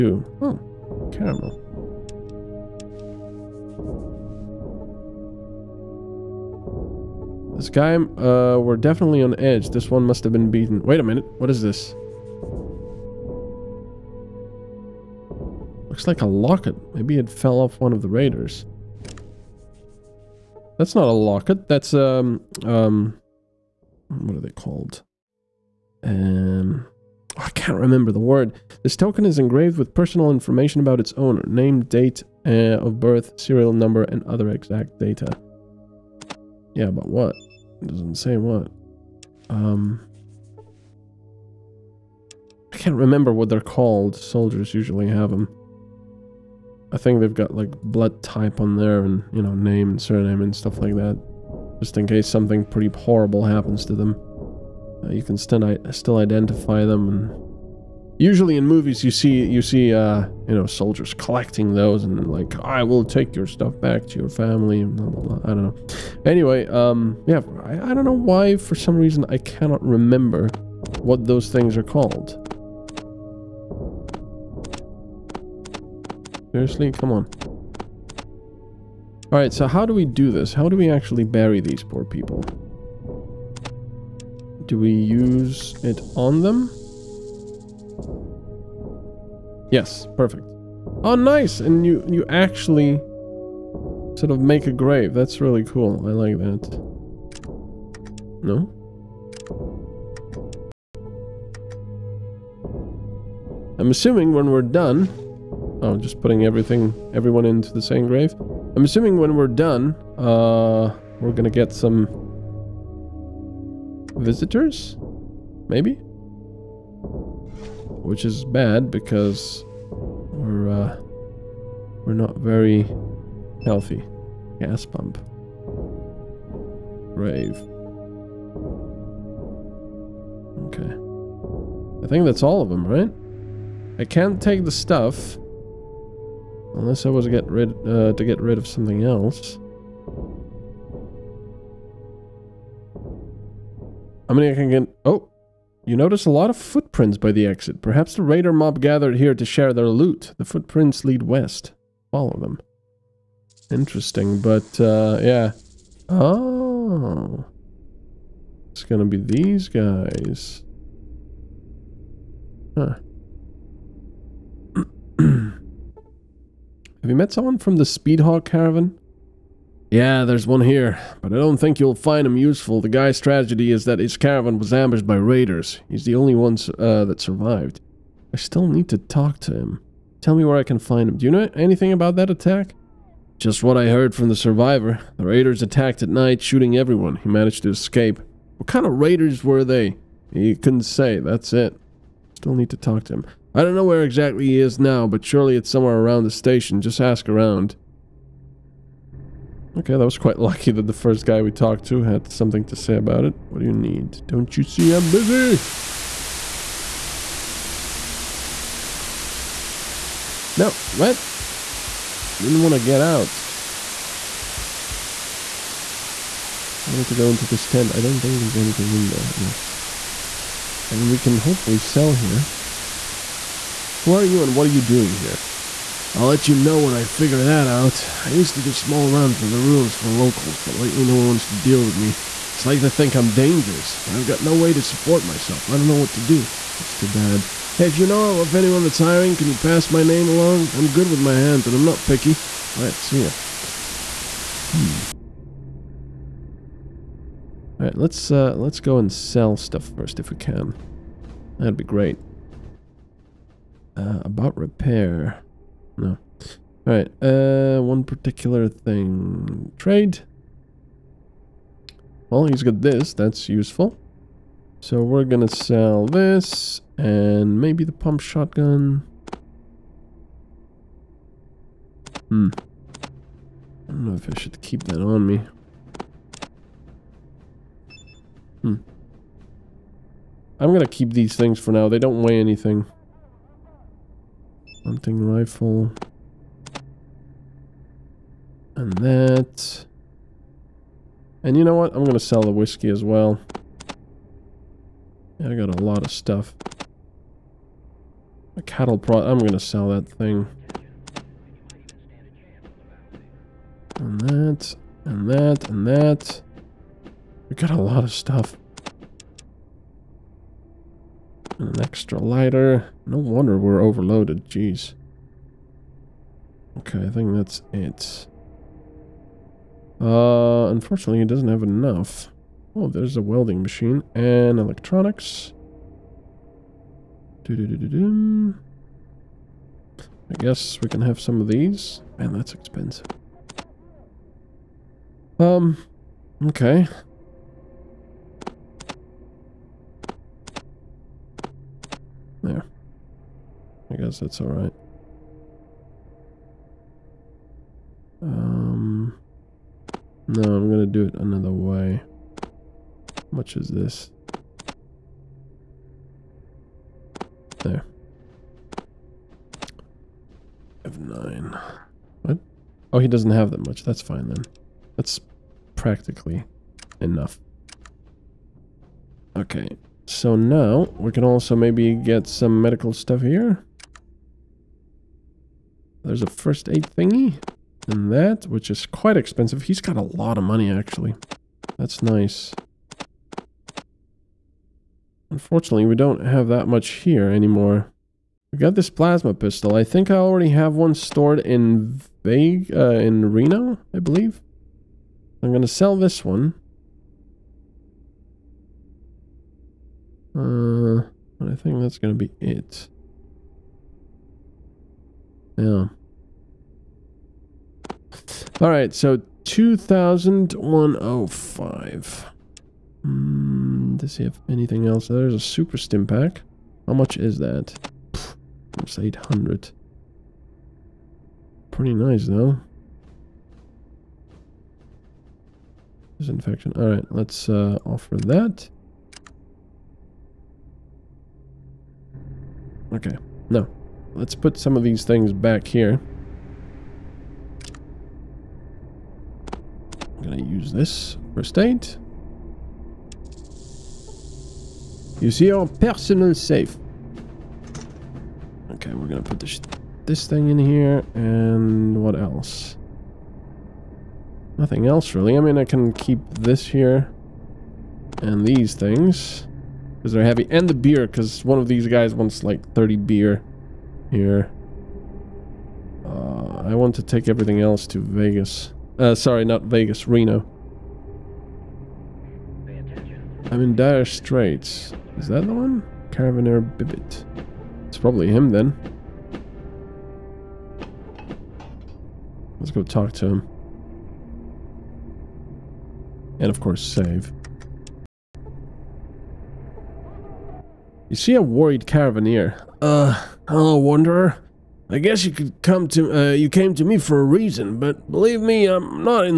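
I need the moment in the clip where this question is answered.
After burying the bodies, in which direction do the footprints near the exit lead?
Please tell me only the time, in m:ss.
2:31.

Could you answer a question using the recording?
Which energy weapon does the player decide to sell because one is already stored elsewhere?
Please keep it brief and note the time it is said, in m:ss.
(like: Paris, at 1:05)
Plasma pistol, at 6:28.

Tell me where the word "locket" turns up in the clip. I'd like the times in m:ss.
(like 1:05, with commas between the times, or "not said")
0:16, 0:21.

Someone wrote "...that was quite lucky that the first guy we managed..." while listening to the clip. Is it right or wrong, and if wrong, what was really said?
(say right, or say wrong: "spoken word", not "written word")
wrong: "talked", not "managed".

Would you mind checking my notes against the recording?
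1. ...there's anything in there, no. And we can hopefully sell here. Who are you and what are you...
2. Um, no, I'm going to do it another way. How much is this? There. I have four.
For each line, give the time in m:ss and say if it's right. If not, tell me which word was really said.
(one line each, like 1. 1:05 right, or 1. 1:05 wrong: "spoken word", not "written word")
1. 3:38 right
2. 5:48 wrong: "nine", not "four".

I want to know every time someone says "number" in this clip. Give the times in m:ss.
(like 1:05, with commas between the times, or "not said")
0:33.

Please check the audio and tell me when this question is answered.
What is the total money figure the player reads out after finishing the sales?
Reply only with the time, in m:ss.
6:49.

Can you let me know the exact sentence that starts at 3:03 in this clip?
Just what I heard from the survivor.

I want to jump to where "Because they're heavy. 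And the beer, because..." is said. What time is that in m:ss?
7:40.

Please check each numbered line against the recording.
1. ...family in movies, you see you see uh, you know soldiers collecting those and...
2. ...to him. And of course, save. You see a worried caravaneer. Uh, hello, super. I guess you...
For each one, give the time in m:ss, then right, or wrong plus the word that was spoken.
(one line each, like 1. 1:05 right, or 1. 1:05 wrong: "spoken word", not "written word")
1. 0:58 wrong: "usually", not "family"
2. 8:03 wrong: "wanderer", not "super".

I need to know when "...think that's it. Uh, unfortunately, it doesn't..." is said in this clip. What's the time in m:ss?
5:17.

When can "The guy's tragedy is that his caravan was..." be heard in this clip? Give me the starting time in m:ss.
2:52.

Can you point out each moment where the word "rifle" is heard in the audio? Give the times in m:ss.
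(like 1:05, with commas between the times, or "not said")
4:45.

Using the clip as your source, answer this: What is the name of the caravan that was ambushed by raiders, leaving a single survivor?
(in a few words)
Speedhawk caravan.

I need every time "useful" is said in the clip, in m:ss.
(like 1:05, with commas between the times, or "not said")
2:52, 4:23.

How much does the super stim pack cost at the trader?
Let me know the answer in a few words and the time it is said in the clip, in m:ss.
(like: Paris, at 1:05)
800, at 6:58.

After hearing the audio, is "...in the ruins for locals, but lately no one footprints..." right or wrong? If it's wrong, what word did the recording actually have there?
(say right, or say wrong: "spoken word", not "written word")
wrong: "wants", not "footprints".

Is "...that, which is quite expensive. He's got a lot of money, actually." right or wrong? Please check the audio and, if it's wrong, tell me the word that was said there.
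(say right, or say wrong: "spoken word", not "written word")
right.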